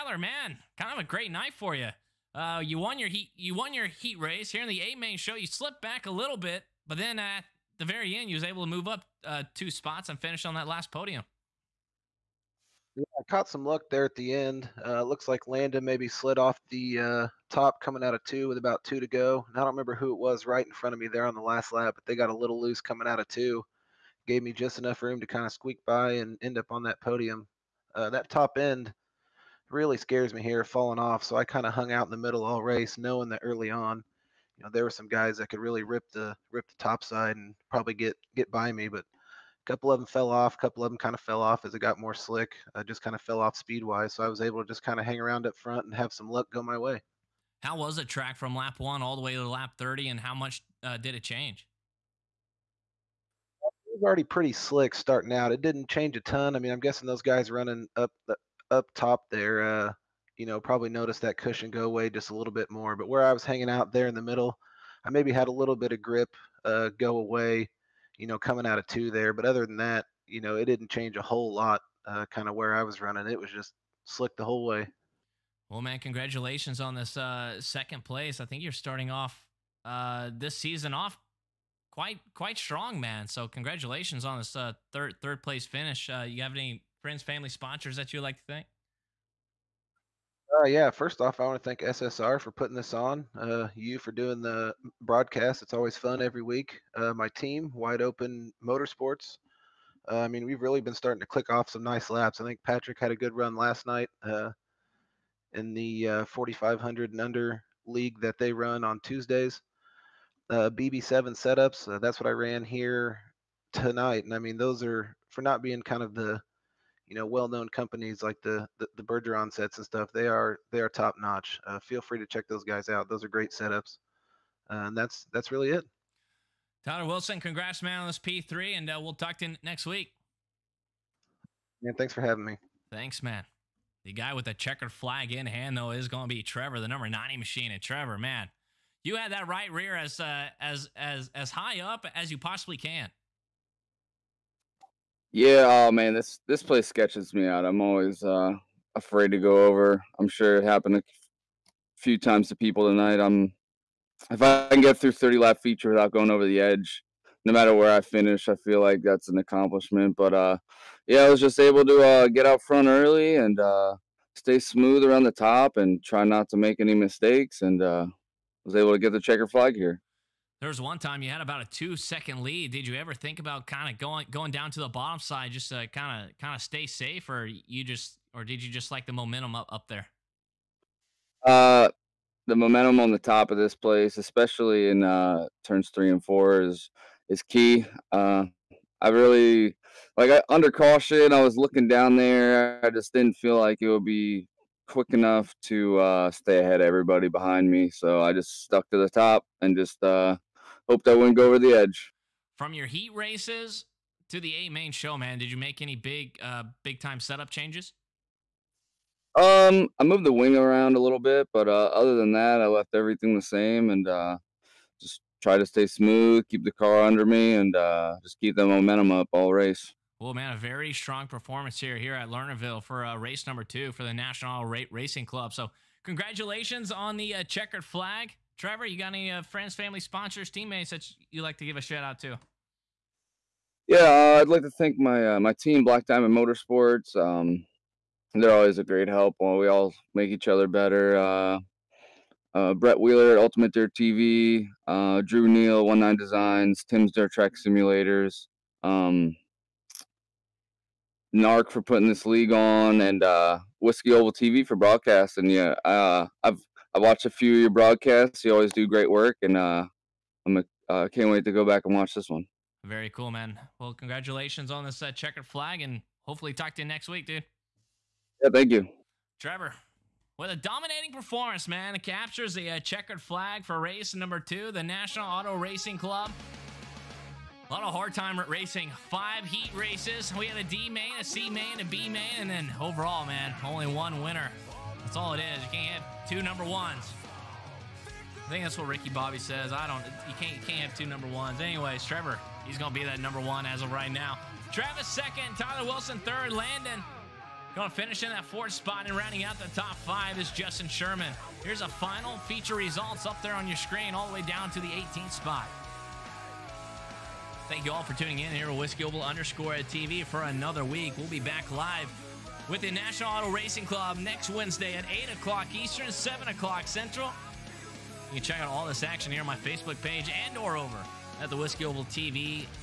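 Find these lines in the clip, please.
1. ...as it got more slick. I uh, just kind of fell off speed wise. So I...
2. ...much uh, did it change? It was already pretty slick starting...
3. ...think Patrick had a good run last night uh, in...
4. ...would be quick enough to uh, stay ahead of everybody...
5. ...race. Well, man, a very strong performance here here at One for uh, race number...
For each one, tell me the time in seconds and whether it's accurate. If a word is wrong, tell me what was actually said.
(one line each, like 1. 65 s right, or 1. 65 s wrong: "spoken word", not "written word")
1. 41 s right
2. 50 s right
3. 102 s right
4. 193 s right
5. 219 s wrong: "Lernerville", not "One".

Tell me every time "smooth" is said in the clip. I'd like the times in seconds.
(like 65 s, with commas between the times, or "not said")
164 s, 215 s.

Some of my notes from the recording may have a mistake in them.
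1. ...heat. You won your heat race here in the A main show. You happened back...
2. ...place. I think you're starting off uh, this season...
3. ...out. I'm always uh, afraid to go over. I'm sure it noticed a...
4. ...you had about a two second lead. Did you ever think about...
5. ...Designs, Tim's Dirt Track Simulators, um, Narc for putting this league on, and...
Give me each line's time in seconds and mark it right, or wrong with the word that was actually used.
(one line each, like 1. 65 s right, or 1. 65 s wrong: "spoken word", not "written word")
1. 3 s wrong: "slipped", not "happened"
2. 78 s right
3. 147 s wrong: "happened", not "noticed"
4. 171 s right
5. 246 s right.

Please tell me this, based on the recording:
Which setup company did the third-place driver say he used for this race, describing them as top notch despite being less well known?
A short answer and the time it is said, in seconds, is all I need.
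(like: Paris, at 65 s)
BB7 setups, at 110 s.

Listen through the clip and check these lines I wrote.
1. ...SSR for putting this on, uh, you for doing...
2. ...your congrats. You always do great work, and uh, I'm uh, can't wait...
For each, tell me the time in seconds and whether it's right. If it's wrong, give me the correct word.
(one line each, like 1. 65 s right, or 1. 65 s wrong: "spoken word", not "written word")
1. 91 s right
2. 257 s wrong: "broadcasts", not "congrats".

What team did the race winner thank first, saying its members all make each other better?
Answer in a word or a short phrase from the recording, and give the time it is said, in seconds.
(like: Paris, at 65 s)
Black Diamond Motorsports, at 235 s.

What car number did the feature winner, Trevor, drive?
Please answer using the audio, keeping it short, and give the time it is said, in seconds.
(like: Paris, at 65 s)
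90, at 136 s.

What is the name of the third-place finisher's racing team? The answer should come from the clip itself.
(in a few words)
Wide Open Motorsports.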